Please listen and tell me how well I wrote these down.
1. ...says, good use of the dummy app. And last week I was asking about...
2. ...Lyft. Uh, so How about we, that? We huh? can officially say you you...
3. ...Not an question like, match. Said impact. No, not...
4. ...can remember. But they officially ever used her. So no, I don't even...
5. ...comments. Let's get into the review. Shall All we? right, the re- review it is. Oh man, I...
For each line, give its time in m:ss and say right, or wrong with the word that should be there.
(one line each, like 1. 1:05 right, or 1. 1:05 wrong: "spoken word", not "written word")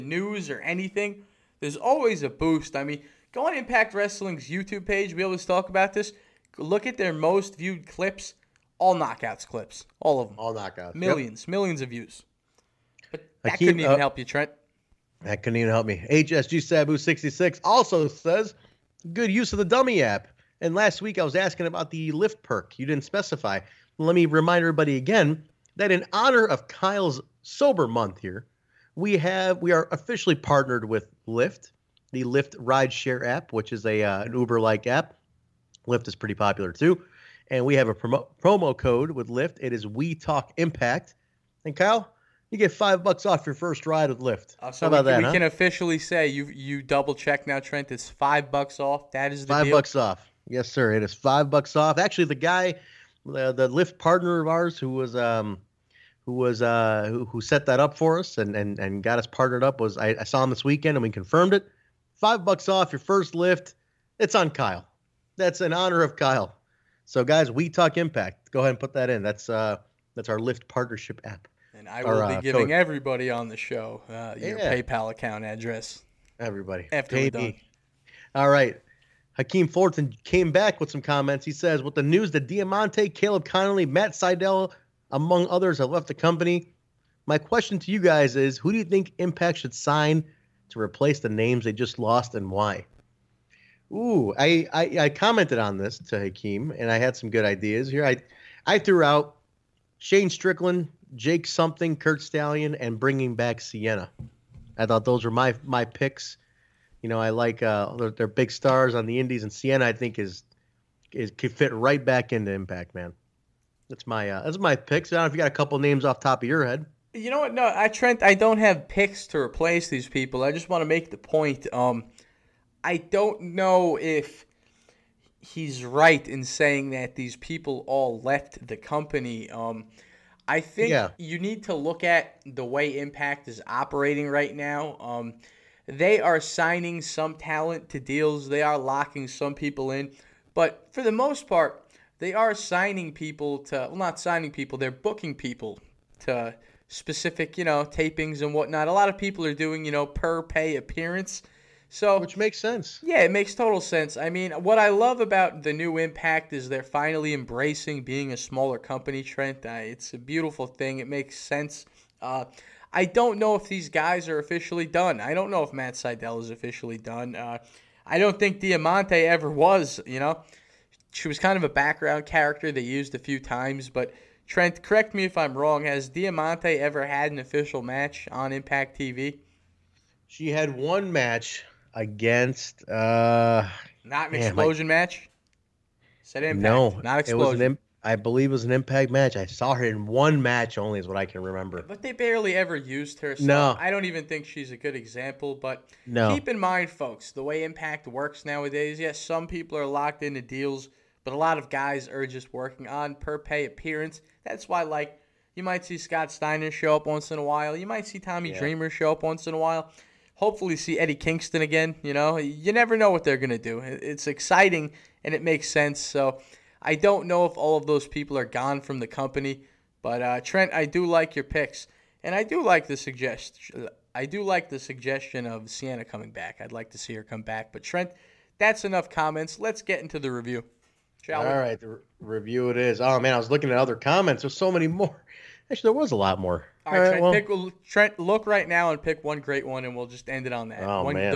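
1. 0:18 right
2. 0:44 right
3. 3:04 wrong: "explosion", not "question"
4. 3:11 wrong: "barely", not "officially"
5. 3:49 right.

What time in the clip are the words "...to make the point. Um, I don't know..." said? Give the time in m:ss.
2:00.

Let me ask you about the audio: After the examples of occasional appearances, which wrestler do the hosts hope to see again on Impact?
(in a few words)
Eddie Kingston.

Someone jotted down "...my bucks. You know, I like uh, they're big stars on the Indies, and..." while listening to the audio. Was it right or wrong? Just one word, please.
wrong.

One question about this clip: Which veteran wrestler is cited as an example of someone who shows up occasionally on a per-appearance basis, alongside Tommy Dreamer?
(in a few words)
Scott Steiner.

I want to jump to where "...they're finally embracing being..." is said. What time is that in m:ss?
2:36.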